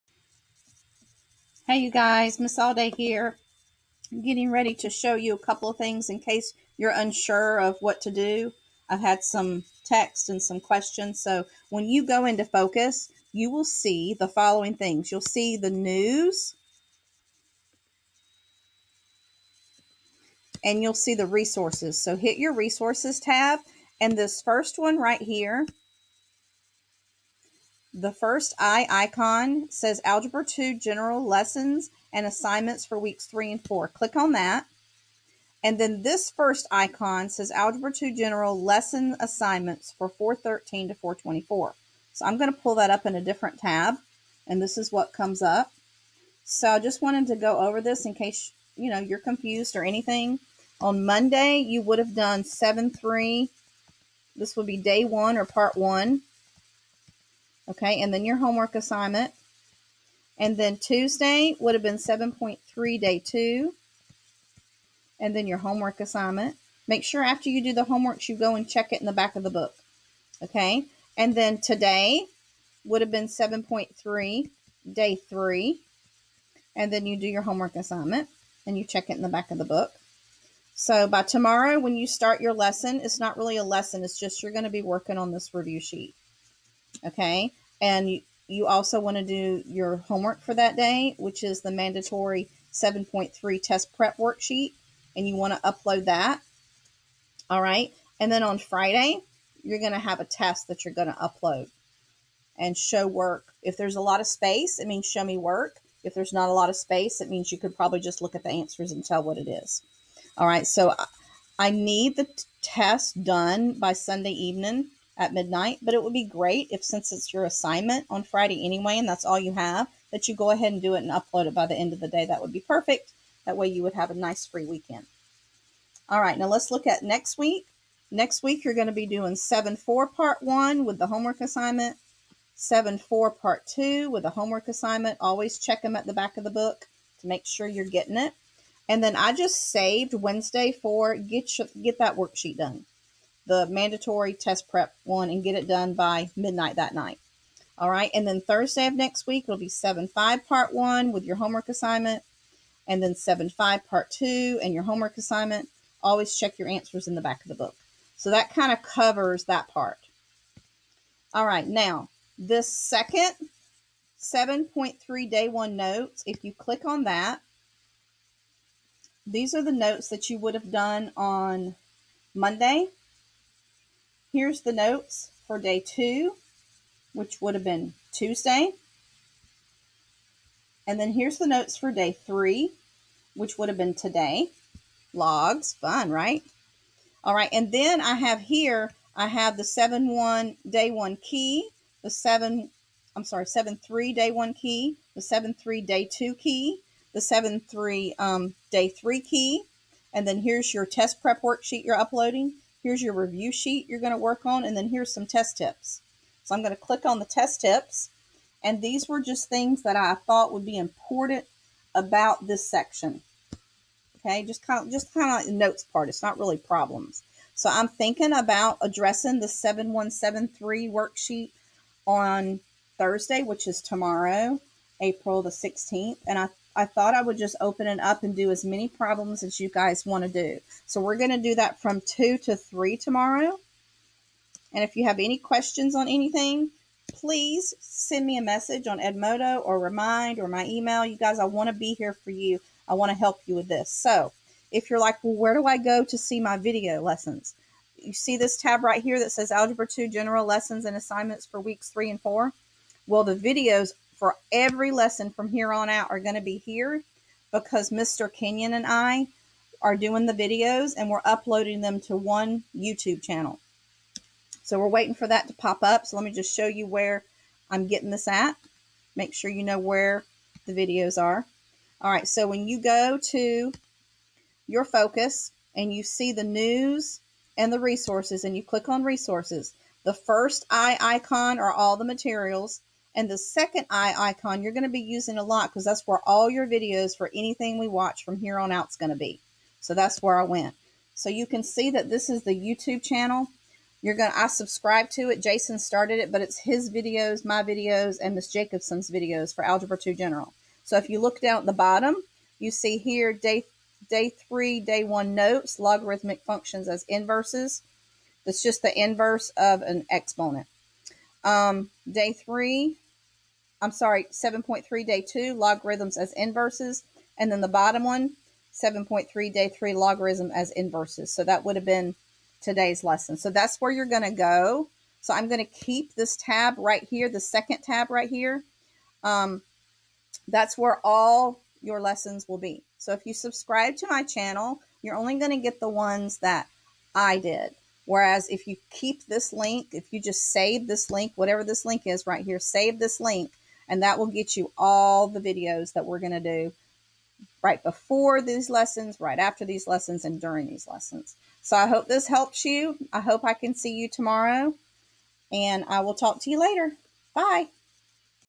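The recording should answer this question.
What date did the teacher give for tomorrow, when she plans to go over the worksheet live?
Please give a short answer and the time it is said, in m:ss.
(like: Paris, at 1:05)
April 16, at 3:45.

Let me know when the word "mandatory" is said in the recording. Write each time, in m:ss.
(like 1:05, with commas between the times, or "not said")
1:31, 2:23.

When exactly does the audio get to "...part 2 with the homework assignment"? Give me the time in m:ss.
2:13.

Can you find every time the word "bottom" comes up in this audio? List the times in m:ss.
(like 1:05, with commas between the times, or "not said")
5:01, 5:17.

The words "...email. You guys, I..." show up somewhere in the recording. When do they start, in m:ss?
4:00.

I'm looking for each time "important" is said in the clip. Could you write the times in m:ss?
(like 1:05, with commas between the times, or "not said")
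3:30.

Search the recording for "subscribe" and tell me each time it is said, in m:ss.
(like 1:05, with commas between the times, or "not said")
4:54, 5:33.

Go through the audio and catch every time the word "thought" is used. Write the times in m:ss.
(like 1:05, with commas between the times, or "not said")
3:30, 3:46.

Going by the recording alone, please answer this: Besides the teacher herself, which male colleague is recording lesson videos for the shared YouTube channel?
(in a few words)
Mr. Kenyon.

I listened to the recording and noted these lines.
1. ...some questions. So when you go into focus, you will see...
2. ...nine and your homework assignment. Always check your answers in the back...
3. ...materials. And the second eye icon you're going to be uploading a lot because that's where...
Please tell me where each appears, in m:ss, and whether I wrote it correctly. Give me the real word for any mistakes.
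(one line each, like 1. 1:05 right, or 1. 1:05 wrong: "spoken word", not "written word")
1. 0:10 right
2. 2:34 wrong: "two", not "nine"
3. 4:42 wrong: "using", not "uploading".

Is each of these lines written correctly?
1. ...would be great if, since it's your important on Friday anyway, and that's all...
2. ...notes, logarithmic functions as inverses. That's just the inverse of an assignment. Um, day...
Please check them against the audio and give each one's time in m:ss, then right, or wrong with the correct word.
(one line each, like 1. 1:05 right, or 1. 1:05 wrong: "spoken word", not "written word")
1. 1:56 wrong: "assignment", not "important"
2. 5:05 wrong: "exponent", not "assignment".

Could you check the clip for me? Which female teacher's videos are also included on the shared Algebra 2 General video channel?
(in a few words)
Miss Jacobson.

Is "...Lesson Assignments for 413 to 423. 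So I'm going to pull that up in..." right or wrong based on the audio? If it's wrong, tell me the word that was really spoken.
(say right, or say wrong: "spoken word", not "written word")
wrong: "424", not "423".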